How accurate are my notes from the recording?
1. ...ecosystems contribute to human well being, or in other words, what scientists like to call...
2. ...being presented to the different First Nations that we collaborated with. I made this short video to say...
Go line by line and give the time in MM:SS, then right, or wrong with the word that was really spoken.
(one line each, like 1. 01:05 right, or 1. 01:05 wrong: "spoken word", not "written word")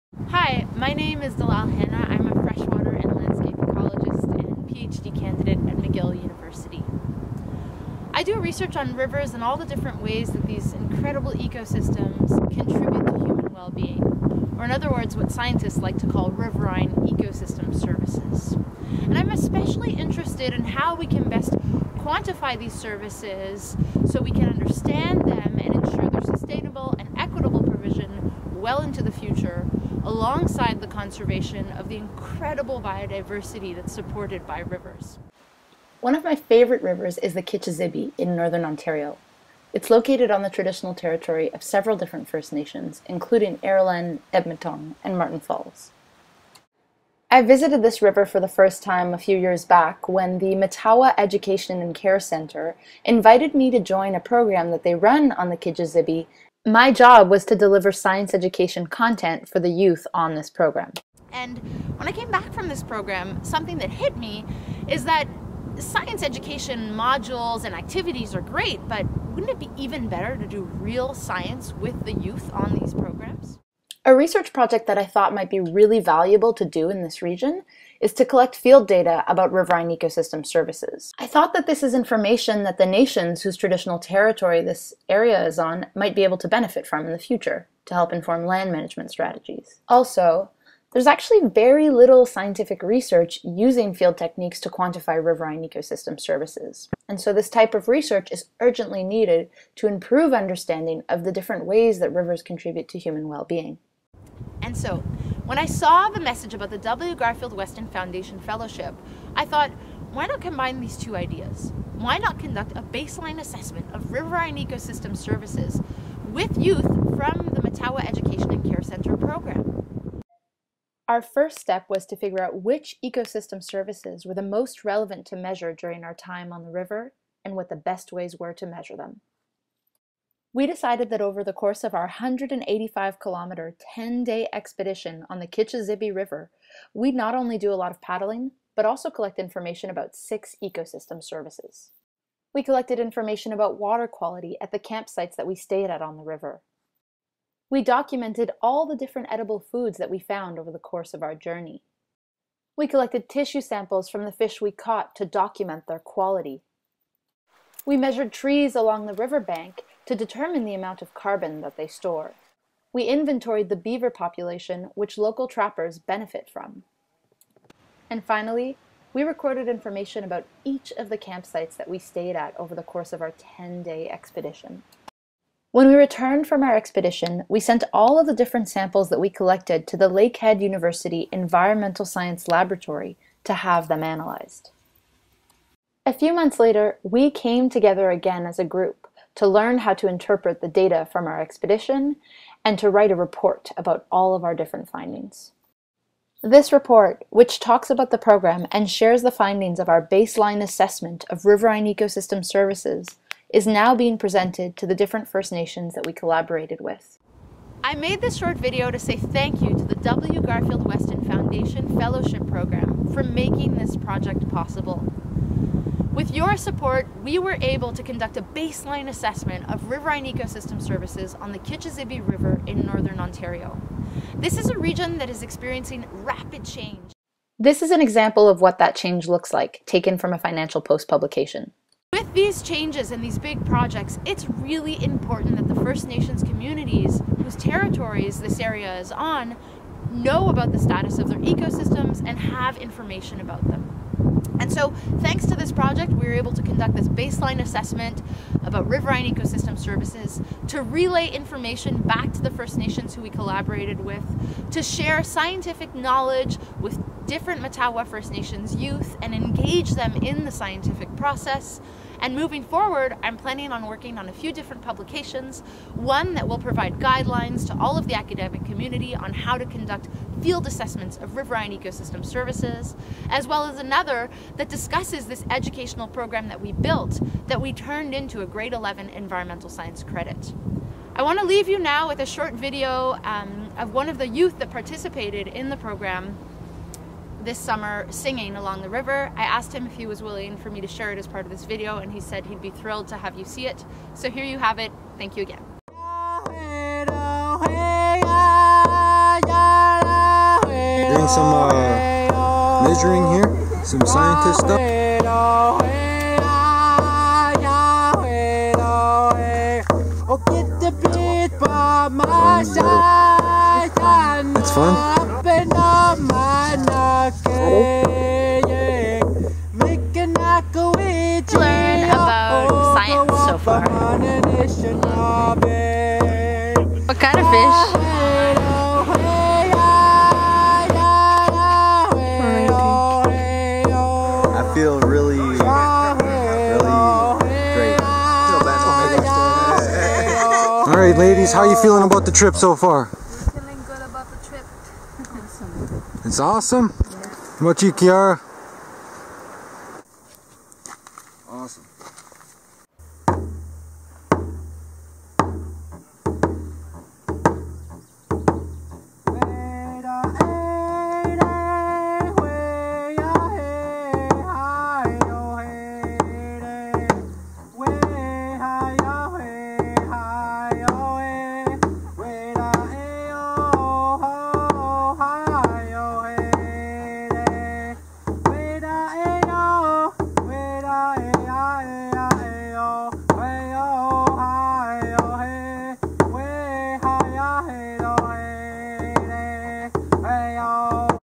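1. 00:11 right
2. 03:23 right.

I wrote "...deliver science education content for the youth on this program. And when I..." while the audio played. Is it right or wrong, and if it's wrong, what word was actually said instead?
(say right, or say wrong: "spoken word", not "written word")
right.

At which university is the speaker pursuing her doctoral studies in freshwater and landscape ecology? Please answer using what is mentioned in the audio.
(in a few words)
McGill University.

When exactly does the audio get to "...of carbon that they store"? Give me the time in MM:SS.
02:41.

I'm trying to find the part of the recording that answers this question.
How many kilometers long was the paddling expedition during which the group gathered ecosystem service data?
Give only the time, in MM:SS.
02:12.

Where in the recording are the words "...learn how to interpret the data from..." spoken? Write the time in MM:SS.
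03:09.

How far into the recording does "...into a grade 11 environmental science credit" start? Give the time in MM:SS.
04:38.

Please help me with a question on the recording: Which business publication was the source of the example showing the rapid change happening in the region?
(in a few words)
Financial Post.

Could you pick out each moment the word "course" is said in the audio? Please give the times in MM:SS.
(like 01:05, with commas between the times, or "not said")
02:11, 02:30, 02:52.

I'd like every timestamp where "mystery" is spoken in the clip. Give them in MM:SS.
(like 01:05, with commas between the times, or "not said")
not said.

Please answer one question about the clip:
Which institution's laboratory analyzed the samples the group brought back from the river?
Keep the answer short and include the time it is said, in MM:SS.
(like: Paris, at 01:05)
Lakehead University, at 03:00.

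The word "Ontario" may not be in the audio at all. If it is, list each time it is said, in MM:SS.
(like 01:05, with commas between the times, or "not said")
00:38, 03:43.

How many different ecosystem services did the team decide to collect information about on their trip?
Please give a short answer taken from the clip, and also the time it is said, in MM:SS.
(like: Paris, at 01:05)
6, at 02:20.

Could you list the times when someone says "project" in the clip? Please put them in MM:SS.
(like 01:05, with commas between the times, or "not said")
01:14, 03:33, 03:53, 04:05.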